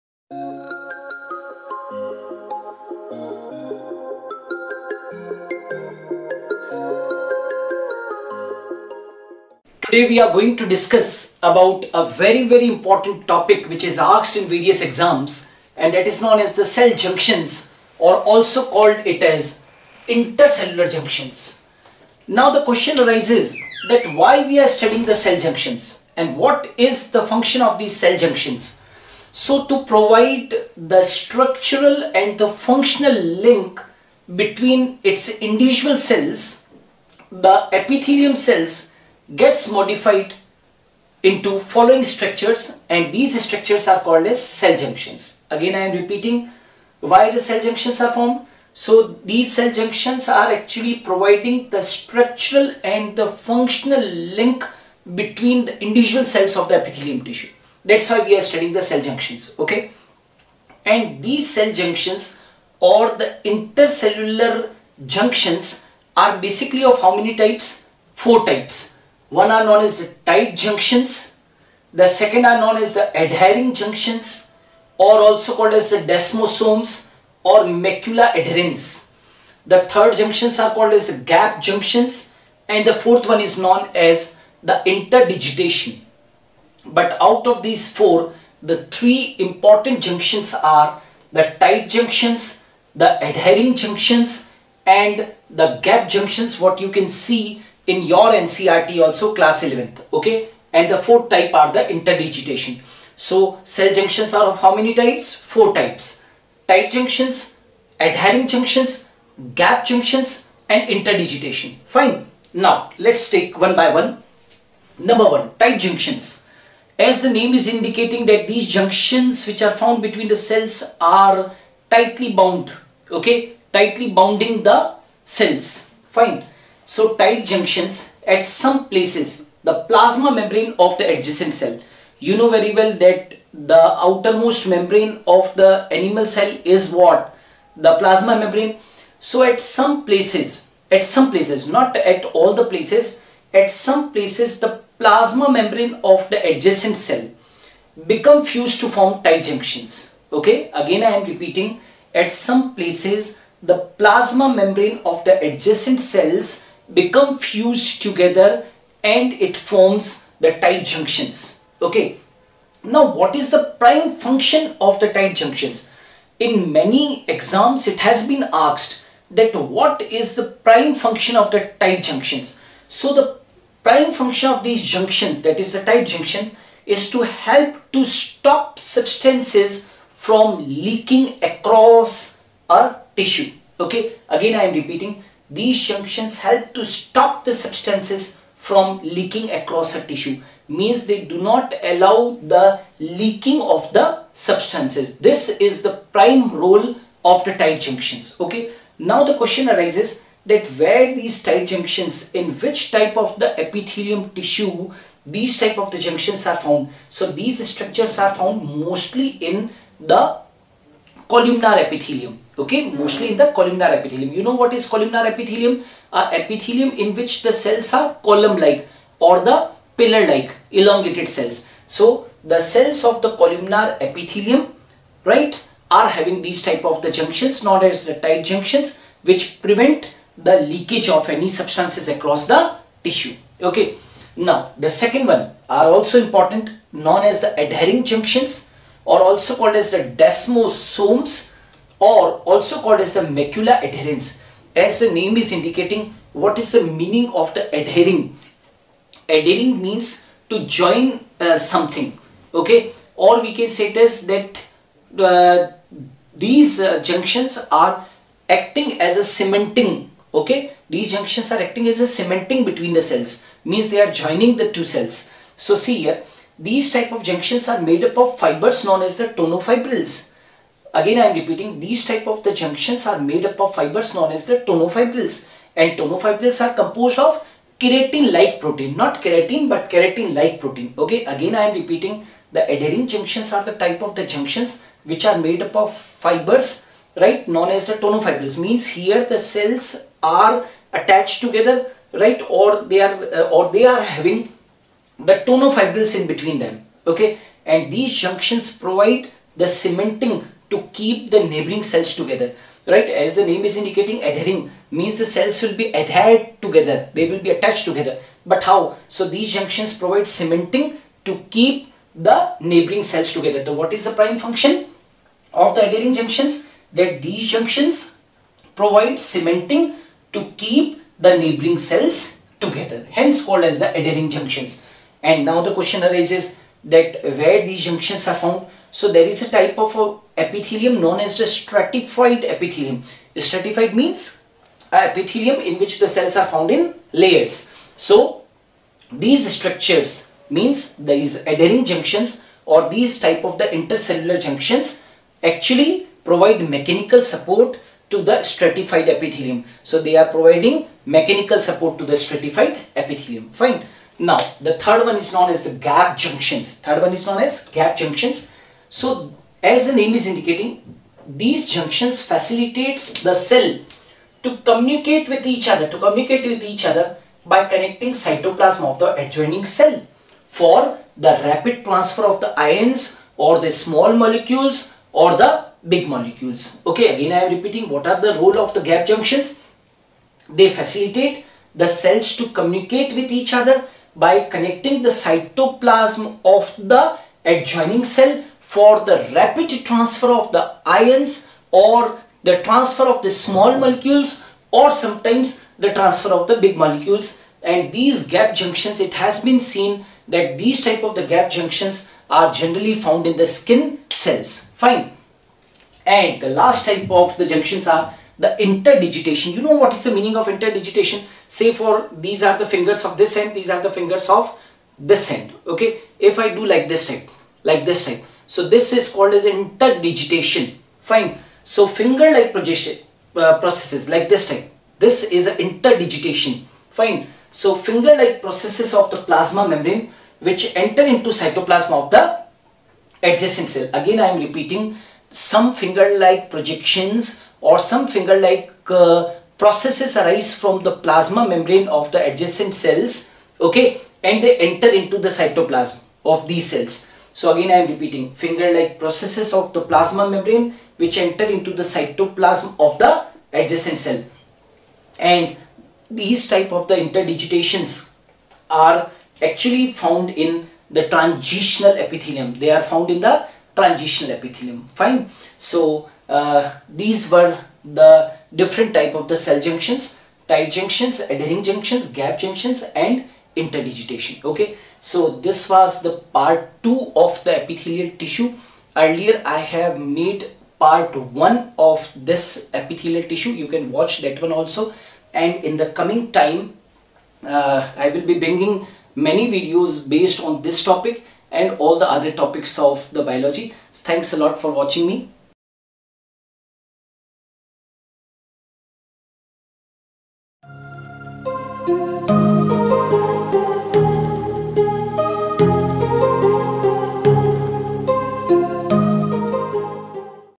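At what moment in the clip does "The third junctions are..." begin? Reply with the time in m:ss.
1:19.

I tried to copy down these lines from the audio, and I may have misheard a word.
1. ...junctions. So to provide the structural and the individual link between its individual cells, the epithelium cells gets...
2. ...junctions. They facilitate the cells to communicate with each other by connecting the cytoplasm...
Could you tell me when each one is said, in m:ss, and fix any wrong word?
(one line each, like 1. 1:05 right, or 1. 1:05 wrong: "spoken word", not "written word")
1. 0:28 wrong: "functional", not "individual"
2. 6:19 right.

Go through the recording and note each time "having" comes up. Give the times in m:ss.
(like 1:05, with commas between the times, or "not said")
3:46, 4:54.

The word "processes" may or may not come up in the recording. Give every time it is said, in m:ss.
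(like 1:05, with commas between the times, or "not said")
7:03, 7:08, 7:19, 7:29.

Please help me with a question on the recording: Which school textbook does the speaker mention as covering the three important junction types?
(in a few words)
NCERT class 11th.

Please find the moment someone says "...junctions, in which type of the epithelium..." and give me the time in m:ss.
3:21.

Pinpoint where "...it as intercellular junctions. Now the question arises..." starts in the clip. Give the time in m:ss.
0:19.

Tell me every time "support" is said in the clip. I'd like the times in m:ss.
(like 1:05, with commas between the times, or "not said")
5:47, 5:51.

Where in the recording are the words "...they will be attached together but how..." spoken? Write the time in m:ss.
5:07.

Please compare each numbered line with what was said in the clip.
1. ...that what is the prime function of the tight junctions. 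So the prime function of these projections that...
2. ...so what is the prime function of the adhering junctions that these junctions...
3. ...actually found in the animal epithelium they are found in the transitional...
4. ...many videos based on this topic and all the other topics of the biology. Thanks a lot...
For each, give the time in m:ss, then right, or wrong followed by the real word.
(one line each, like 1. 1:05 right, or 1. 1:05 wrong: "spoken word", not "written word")
1. 2:49 wrong: "junctions", not "projections"
2. 5:13 right
3. 7:39 wrong: "transitional", not "animal"
4. 8:09 right.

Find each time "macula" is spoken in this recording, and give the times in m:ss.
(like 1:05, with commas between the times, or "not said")
1:17, 4:03.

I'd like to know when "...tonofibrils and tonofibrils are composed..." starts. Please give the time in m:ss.
4:34.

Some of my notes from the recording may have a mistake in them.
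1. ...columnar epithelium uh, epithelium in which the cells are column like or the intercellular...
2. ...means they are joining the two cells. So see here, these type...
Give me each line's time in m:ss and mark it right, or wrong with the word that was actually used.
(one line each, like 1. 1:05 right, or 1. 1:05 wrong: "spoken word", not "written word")
1. 3:34 wrong: "pillar", not "intercellular"
2. 4:23 right.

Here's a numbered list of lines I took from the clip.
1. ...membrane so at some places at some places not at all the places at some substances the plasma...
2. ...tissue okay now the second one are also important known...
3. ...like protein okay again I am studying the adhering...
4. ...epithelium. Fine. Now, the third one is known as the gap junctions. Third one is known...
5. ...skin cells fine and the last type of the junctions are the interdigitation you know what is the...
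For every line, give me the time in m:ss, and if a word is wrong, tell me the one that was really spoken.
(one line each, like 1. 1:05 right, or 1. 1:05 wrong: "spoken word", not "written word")
1. 2:18 wrong: "places", not "substances"
2. 3:53 right
3. 4:40 wrong: "repeating", not "studying"
4. 5:52 right
5. 6:43 right.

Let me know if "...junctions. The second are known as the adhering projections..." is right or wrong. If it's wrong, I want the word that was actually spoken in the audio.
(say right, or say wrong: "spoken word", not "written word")
wrong: "junctions", not "projections".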